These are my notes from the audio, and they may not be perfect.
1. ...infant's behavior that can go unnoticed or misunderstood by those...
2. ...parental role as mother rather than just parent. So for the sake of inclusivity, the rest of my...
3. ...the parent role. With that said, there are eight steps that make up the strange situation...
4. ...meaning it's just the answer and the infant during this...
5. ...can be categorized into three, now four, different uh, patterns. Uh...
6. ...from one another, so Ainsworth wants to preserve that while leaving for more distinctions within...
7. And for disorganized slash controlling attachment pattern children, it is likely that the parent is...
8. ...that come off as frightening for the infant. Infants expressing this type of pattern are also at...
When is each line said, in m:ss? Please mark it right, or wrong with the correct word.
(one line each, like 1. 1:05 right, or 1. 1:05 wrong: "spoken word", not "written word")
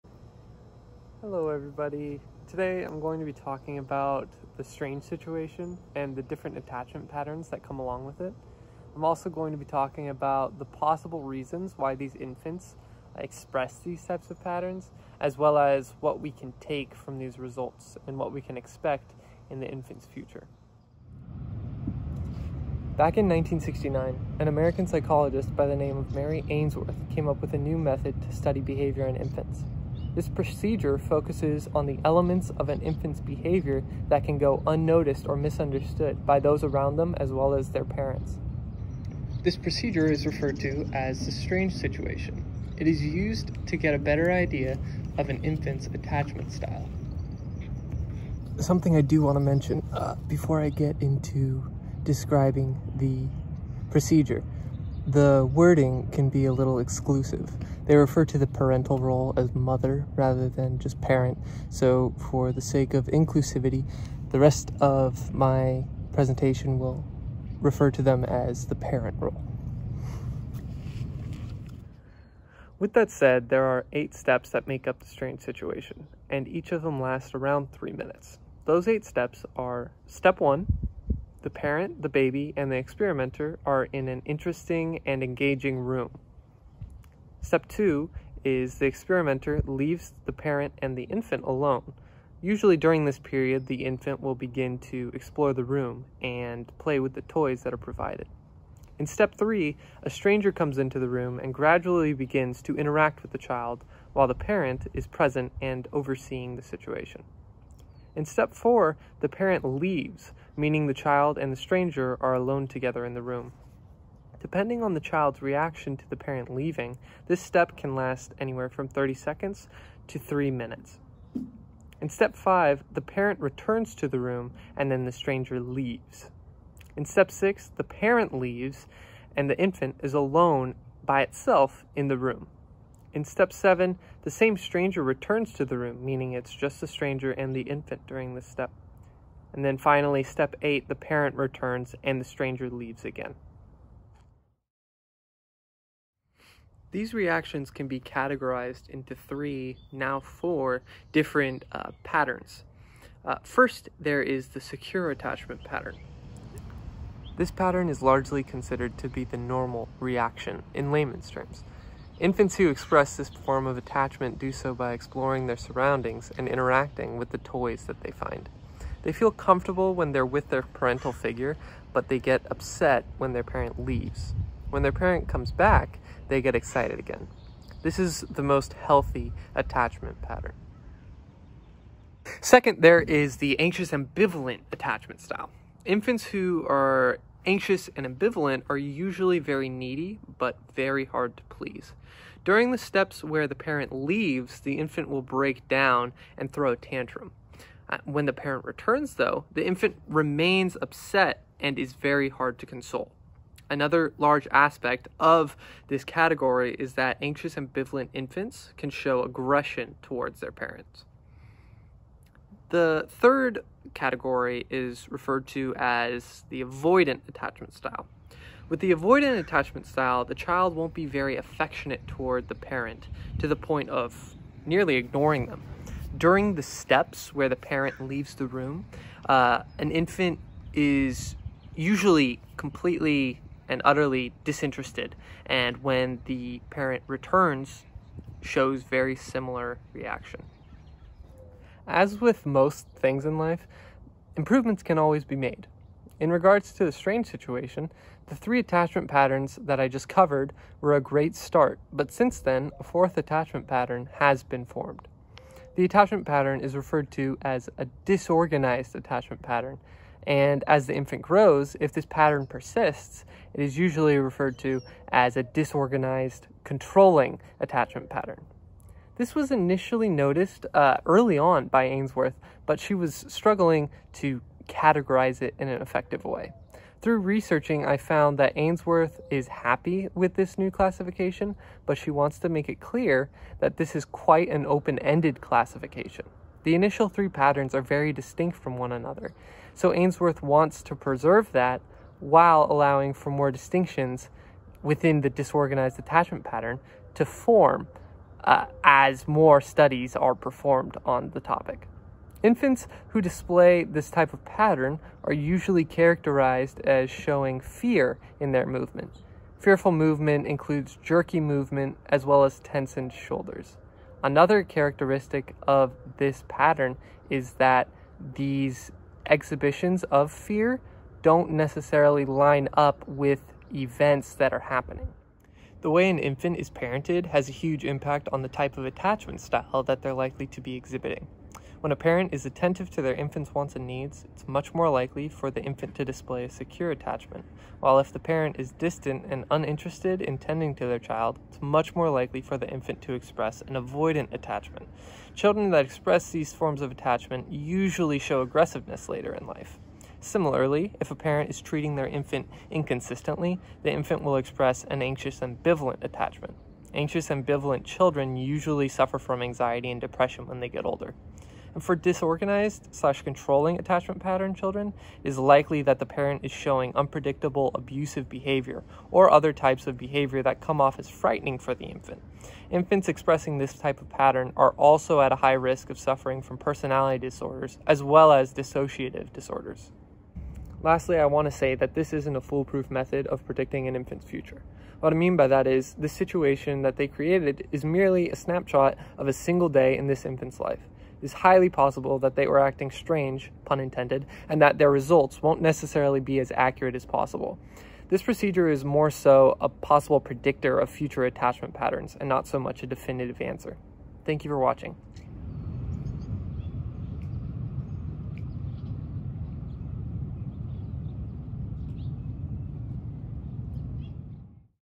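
1. 0:32 right
2. 0:58 right
3. 1:08 right
4. 2:16 wrong: "stranger", not "answer"
5. 2:27 right
6. 4:48 wrong: "allowing", not "leaving"
7. 6:01 right
8. 6:10 right.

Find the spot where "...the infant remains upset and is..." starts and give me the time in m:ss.
3:19.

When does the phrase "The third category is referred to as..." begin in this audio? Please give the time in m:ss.
3:32.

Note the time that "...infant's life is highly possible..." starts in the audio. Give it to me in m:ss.
6:30.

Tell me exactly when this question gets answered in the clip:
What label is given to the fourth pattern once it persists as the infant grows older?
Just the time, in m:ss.
4:25.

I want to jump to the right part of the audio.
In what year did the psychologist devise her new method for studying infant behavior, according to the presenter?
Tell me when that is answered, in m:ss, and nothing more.
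0:23.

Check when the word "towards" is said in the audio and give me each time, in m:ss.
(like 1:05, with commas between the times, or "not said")
3:30, 3:42.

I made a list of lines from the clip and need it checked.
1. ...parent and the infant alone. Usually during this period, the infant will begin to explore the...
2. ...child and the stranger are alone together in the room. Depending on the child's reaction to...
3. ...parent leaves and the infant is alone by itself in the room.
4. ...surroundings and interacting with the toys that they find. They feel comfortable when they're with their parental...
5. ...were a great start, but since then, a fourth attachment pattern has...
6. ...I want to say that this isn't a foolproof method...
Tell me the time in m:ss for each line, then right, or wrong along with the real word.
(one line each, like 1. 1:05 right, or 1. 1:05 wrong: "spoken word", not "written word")
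1. 1:30 right
2. 1:50 right
3. 2:07 right
4. 2:45 right
5. 4:10 right
6. 6:21 right.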